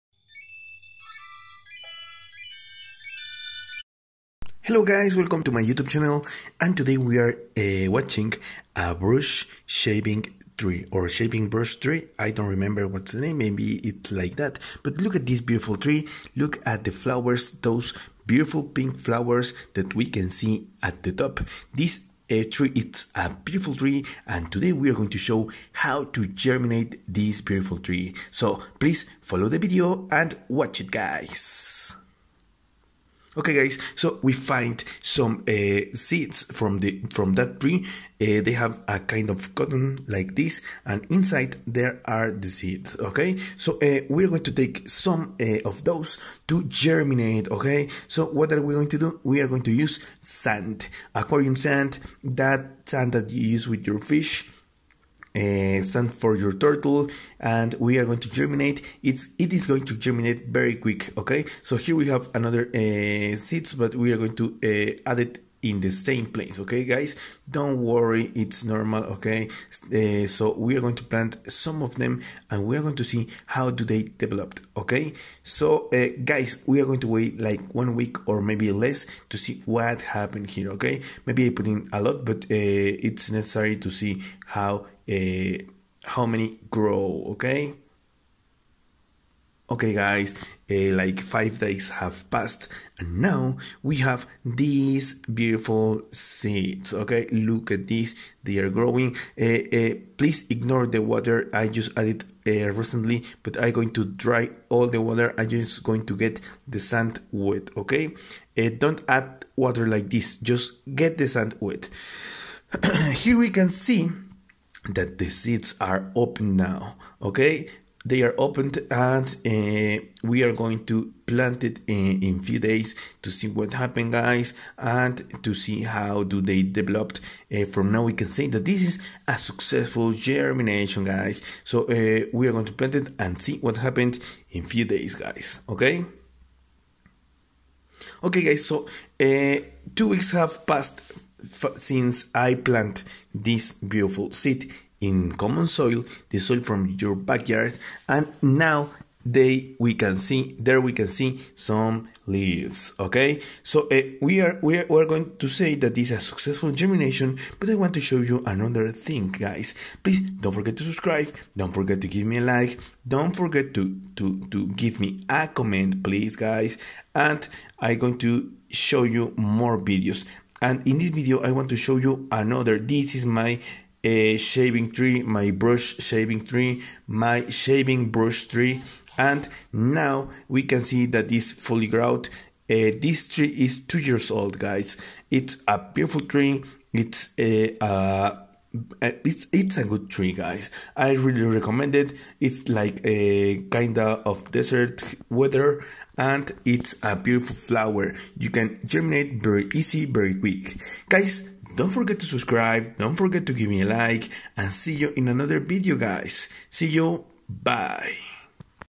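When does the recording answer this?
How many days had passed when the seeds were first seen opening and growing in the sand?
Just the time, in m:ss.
1:31.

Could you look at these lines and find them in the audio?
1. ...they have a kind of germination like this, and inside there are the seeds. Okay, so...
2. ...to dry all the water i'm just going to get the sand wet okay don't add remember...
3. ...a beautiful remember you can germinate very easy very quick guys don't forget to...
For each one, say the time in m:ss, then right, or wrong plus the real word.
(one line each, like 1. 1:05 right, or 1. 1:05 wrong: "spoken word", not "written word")
1. 0:38 wrong: "cotton", not "germination"
2. 1:43 wrong: "water", not "remember"
3. 3:17 wrong: "flower", not "remember".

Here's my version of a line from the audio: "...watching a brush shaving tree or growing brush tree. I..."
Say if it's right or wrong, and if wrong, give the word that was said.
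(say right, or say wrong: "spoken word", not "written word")
wrong: "shaving", not "growing".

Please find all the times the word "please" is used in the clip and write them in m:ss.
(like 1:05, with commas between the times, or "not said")
0:28, 1:40, 2:40, 2:46.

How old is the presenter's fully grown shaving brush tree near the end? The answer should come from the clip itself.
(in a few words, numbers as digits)
2 years.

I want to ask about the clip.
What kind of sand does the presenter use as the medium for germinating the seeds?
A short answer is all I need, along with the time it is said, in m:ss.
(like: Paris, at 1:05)
Aquarium sand, at 0:51.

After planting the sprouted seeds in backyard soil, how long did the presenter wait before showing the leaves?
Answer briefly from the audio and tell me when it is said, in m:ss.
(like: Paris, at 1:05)
2 weeks, at 2:19.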